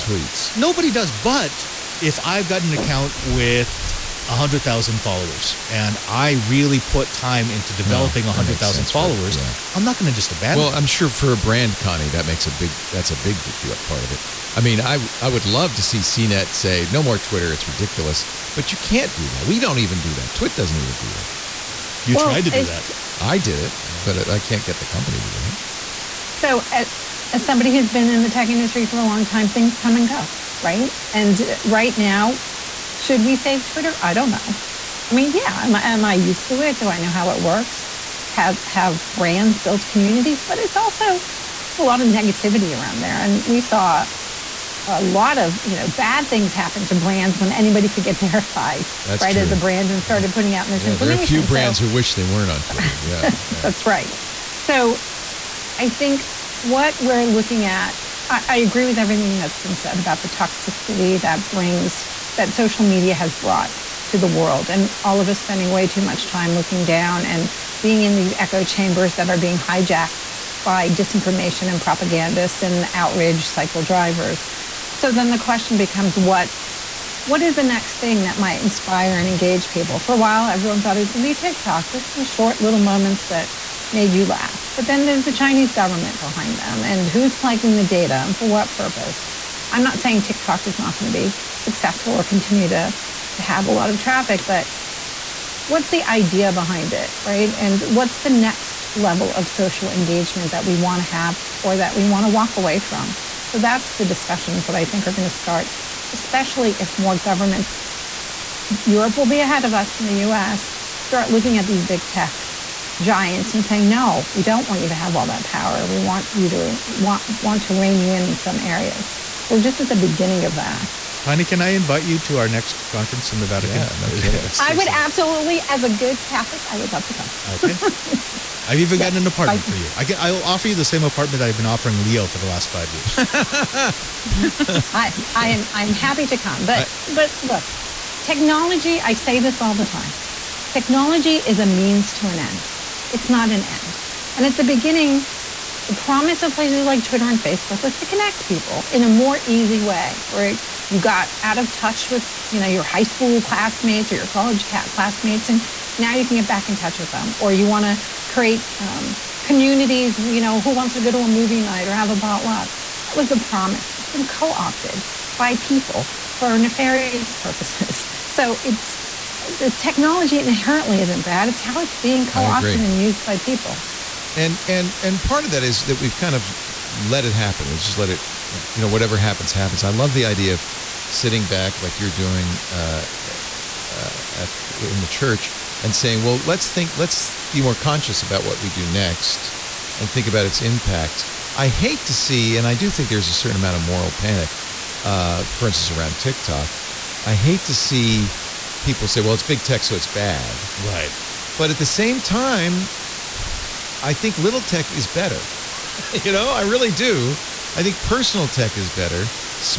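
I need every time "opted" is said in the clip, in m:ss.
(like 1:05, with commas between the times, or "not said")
2:44, 2:52.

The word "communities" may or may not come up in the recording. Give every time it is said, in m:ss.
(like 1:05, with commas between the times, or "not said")
0:39, 2:39.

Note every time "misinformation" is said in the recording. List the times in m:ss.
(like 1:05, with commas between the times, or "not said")
0:50.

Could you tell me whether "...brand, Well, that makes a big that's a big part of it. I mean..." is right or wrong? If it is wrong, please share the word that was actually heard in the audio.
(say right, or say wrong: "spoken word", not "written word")
wrong: "Connie", not "Well".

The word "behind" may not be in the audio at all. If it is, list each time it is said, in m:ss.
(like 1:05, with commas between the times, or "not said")
1:26, 1:36.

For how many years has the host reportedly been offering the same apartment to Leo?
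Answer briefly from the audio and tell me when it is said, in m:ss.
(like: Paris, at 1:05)
5, at 2:12.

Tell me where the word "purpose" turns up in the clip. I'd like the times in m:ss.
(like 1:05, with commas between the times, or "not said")
1:28, 2:47.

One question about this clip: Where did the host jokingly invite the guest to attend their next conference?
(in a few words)
The Vatican.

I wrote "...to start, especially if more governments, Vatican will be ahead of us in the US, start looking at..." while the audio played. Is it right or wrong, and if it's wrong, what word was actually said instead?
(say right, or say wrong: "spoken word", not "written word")
wrong: "Europe", not "Vatican".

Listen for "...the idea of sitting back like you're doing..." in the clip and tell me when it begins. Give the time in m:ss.
3:00.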